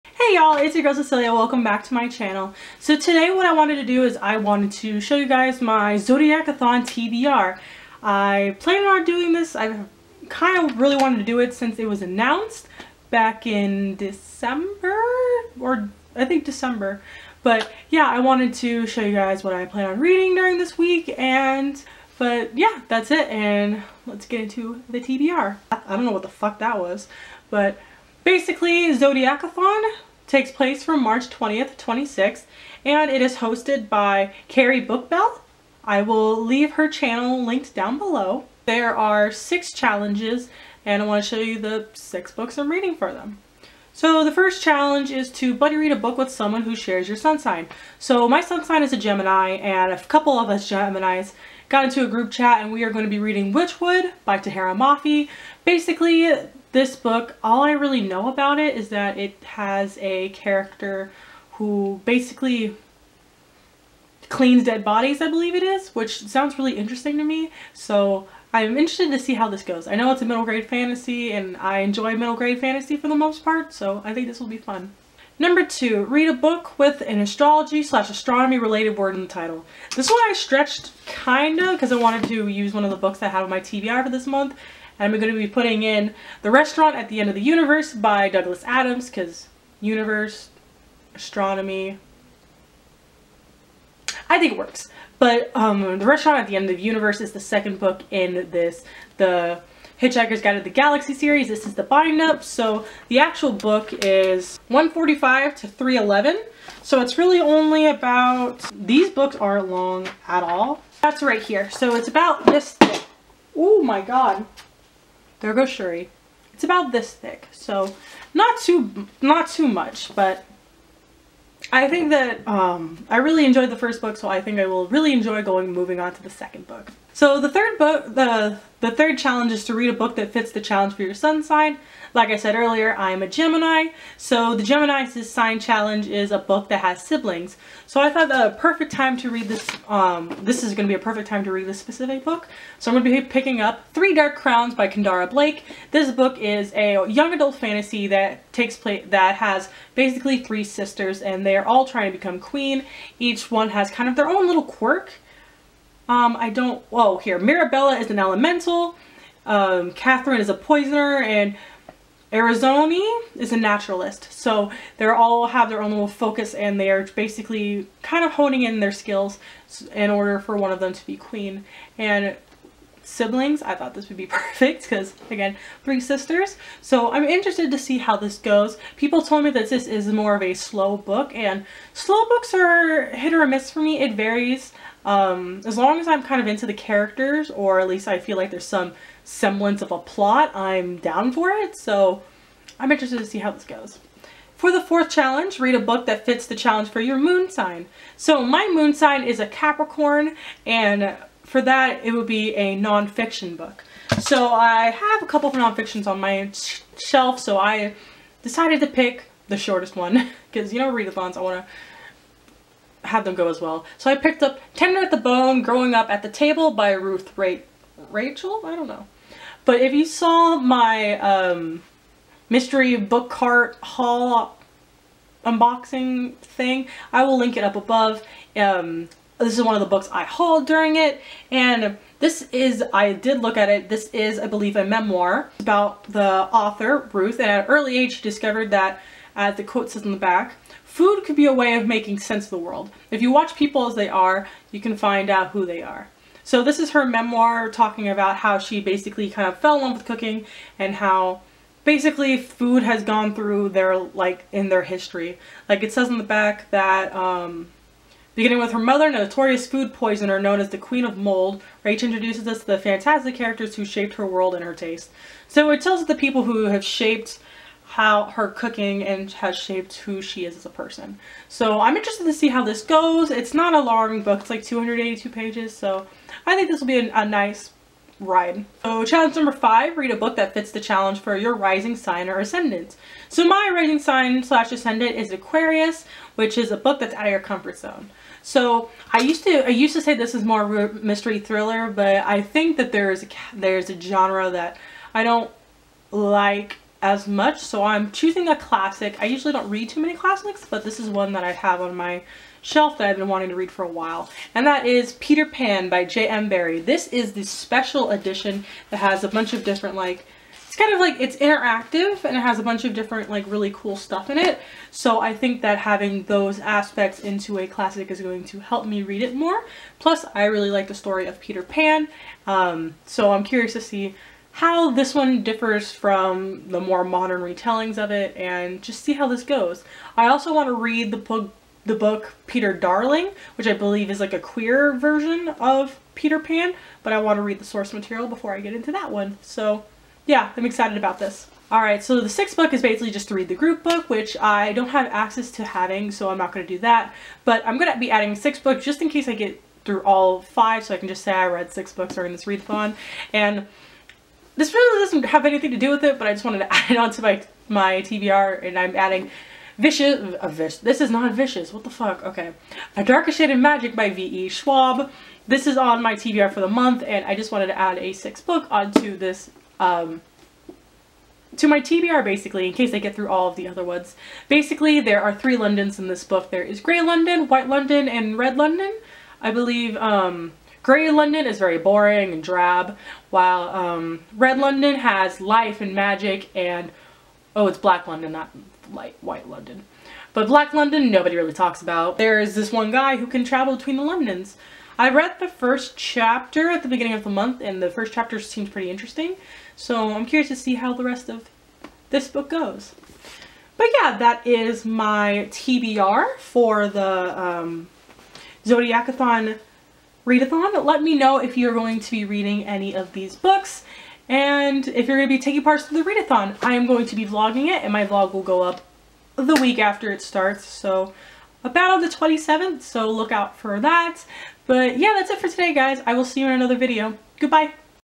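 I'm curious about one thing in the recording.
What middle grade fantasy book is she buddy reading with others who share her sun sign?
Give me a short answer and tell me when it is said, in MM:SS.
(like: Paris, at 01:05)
Whichwood, at 00:53.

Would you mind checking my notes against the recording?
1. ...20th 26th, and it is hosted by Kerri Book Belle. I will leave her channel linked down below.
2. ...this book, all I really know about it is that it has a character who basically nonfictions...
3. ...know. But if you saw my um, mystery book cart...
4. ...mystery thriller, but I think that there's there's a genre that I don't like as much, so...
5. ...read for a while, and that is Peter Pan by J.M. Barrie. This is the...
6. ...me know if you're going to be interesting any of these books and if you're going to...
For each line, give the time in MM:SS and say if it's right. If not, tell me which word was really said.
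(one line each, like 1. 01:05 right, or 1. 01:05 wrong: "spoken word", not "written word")
1. 00:31 right
2. 00:56 wrong: "cleans", not "nonfictions"
3. 03:38 right
4. 04:50 right
5. 05:03 right
6. 06:51 wrong: "reading", not "interesting".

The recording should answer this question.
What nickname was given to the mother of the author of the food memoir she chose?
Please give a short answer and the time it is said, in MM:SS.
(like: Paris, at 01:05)
Queen of Mold, at 04:20.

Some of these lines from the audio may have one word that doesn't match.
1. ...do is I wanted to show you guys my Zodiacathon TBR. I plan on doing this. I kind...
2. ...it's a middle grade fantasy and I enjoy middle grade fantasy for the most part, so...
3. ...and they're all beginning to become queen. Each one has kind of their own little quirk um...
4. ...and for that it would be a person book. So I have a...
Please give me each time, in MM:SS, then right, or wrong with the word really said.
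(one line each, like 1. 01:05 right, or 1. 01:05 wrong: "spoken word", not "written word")
1. 00:03 right
2. 01:10 right
3. 02:31 wrong: "trying", not "beginning"
4. 03:20 wrong: "nonfiction", not "person".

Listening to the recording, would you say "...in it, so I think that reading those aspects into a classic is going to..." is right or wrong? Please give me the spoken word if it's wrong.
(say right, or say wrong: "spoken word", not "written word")
wrong: "having", not "reading".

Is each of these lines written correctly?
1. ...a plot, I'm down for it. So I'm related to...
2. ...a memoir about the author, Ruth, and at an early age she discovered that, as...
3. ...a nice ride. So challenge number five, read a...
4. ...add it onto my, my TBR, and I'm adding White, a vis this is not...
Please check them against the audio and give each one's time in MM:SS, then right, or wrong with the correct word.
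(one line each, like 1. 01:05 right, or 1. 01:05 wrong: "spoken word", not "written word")
1. 03:09 wrong: "interested", not "related"
2. 03:54 right
3. 04:37 right
4. 05:56 wrong: "Vicious", not "White".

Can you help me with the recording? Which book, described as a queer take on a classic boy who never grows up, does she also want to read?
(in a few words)
Peter Darling.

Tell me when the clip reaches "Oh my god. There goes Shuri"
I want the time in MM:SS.
01:53.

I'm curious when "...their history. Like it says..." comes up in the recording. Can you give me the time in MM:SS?
04:14.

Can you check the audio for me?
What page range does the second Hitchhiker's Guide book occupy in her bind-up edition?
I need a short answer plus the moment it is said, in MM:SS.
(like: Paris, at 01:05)
145 to 311, at 01:44.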